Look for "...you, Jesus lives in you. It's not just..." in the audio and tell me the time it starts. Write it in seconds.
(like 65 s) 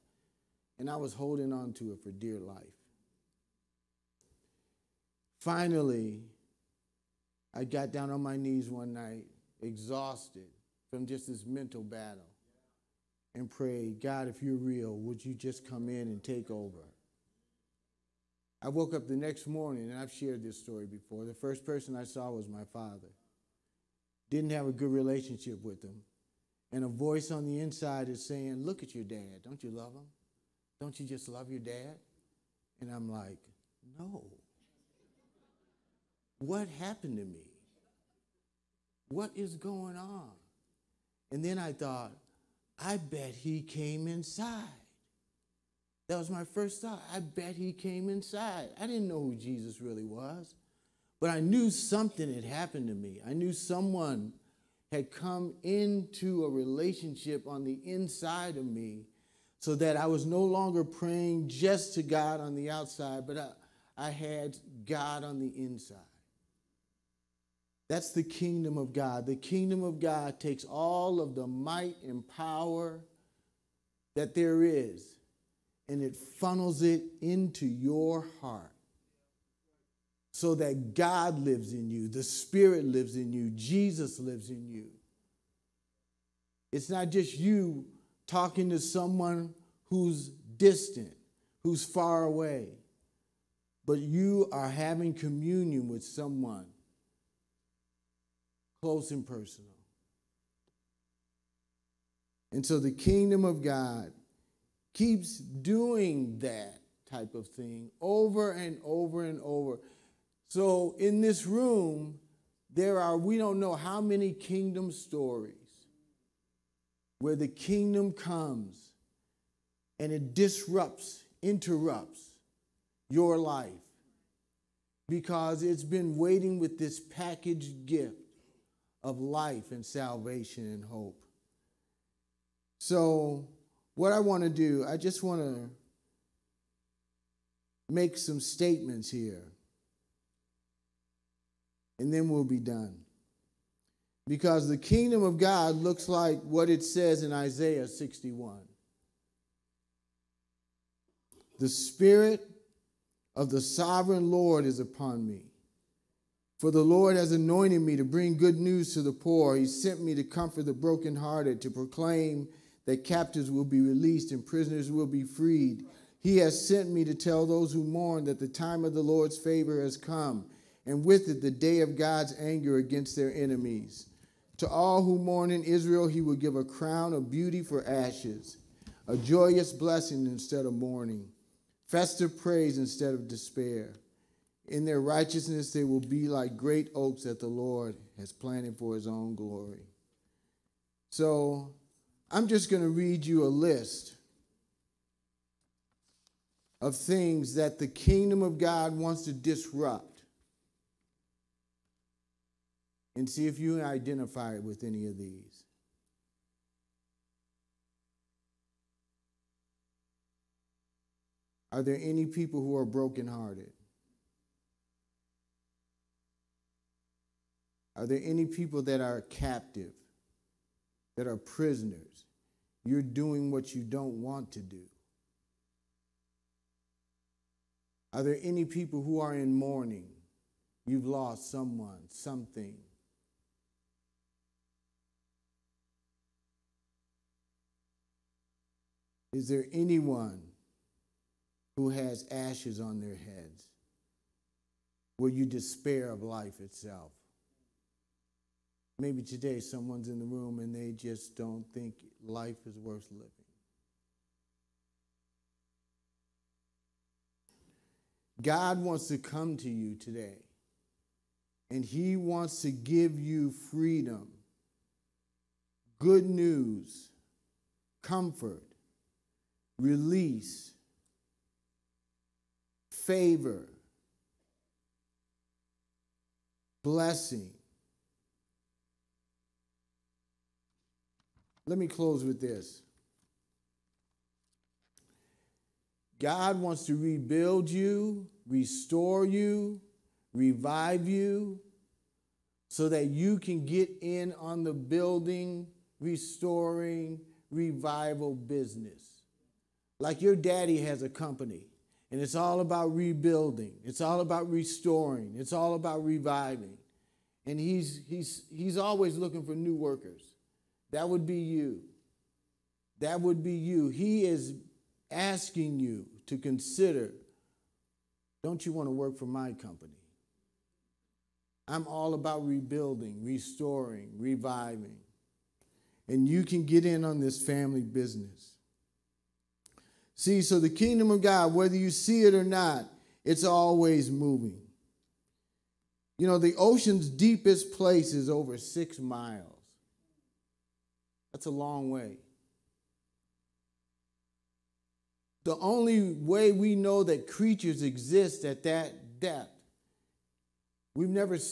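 83 s.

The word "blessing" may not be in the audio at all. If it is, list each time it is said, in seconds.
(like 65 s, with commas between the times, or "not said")
179 s, 276 s.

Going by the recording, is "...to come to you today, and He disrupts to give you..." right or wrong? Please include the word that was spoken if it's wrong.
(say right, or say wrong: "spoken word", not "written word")
wrong: "wants", not "disrupts".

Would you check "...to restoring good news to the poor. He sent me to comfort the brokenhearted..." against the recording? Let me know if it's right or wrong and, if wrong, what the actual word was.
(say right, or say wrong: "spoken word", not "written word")
wrong: "bring", not "restoring".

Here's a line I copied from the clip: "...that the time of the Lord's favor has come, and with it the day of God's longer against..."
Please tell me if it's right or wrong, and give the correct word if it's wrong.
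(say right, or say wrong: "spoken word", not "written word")
wrong: "anger", not "longer".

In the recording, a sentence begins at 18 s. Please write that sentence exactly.
I woke up the next morning, and I've shared this story before.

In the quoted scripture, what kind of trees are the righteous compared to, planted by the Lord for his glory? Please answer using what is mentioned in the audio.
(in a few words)
Great oaks.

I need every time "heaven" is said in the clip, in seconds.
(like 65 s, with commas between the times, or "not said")
not said.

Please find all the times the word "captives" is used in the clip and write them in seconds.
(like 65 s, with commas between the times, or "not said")
163 s, 219 s.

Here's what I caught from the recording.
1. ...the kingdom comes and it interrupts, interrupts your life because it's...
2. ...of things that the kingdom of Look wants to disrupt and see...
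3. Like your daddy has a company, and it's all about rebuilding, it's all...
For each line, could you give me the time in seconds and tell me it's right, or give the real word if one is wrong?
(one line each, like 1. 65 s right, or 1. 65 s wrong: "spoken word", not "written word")
1. 117 s wrong: "disrupts", not "interrupts"
2. 196 s wrong: "God", not "Look"
3. 299 s right.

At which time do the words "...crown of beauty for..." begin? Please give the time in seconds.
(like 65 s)
176 s.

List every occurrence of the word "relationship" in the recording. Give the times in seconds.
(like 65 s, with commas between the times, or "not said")
24 s, 56 s.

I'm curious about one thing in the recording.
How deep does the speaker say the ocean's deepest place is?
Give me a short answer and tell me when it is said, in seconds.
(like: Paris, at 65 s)
Over 6 miles, at 338 s.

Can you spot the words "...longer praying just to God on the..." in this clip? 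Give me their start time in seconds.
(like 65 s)
60 s.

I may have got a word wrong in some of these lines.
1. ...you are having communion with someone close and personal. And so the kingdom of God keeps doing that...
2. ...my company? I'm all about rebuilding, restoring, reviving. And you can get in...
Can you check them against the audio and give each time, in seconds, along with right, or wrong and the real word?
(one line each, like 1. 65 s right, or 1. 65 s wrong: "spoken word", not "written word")
1. 93 s right
2. 319 s right.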